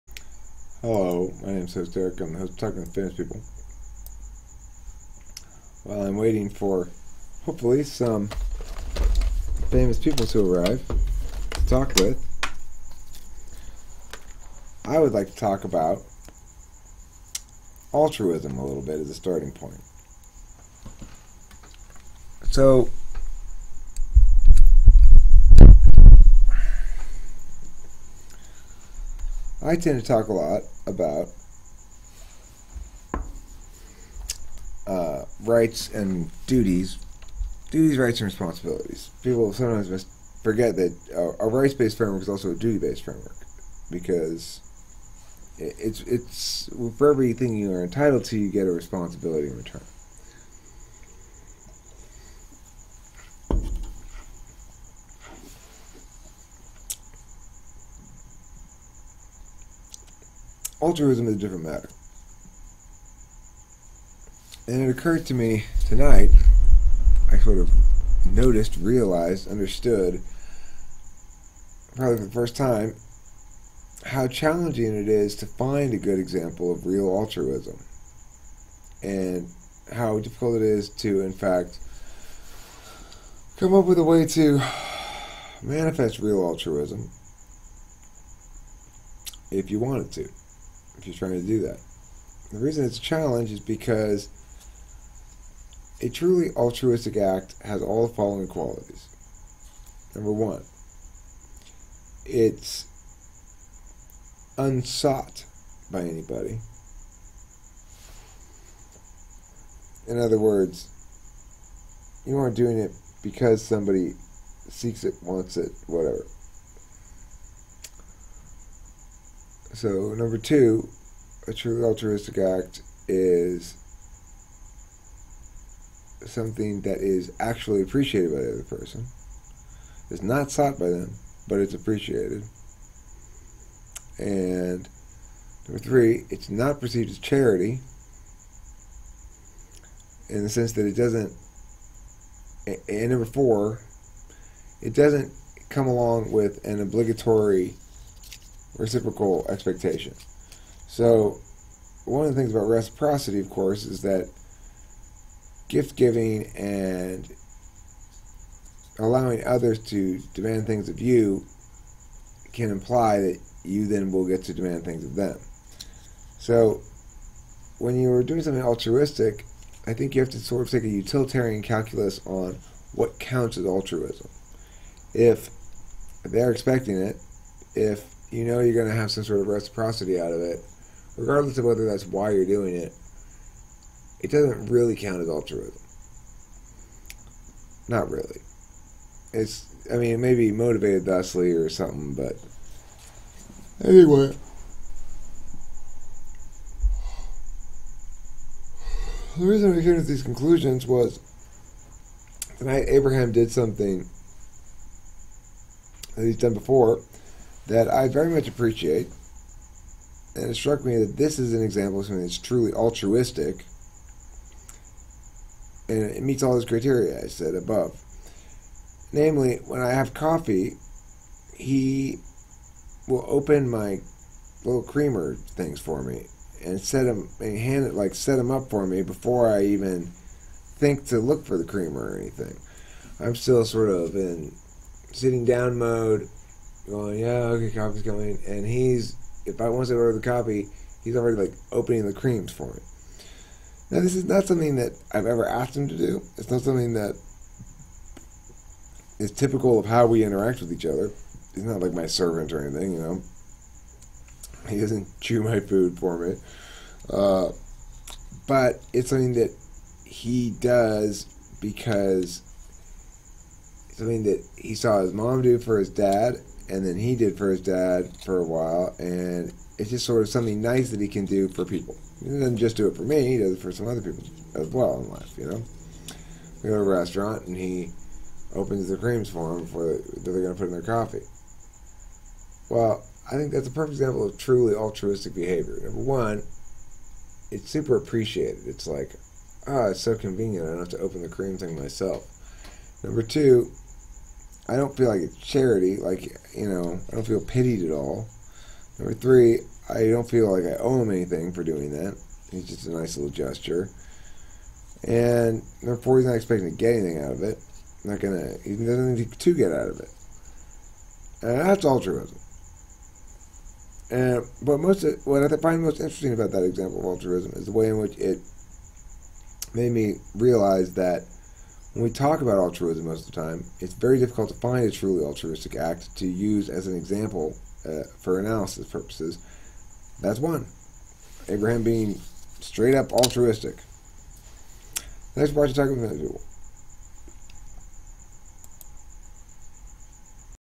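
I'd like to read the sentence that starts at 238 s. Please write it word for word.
And he's, if I once to order the coffee, he's already like opening the creams for me.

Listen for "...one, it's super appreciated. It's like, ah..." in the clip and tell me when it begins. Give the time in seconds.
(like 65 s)
286 s.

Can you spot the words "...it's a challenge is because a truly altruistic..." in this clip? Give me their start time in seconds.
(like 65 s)
92 s.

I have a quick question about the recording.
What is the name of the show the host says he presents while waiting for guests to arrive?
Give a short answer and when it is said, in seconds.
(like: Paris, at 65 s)
Talking to Famous People, at 2 s.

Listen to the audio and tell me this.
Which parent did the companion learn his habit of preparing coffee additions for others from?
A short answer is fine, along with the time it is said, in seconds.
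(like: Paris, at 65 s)
his mom, at 265 s.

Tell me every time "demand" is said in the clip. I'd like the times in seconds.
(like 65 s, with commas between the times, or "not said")
160 s, 164 s.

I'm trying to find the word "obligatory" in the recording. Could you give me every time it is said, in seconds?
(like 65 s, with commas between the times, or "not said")
146 s.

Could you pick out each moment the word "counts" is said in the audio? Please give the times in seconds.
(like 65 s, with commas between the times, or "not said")
173 s, 184 s.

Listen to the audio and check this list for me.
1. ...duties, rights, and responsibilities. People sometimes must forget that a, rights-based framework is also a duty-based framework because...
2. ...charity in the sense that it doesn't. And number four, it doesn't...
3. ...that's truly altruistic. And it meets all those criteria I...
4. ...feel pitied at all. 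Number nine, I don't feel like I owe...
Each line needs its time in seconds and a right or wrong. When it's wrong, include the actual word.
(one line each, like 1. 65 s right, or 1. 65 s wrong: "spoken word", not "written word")
1. 37 s right
2. 137 s right
3. 212 s right
4. 297 s wrong: "three", not "nine".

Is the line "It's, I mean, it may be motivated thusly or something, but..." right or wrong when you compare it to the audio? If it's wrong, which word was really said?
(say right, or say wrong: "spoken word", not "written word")
right.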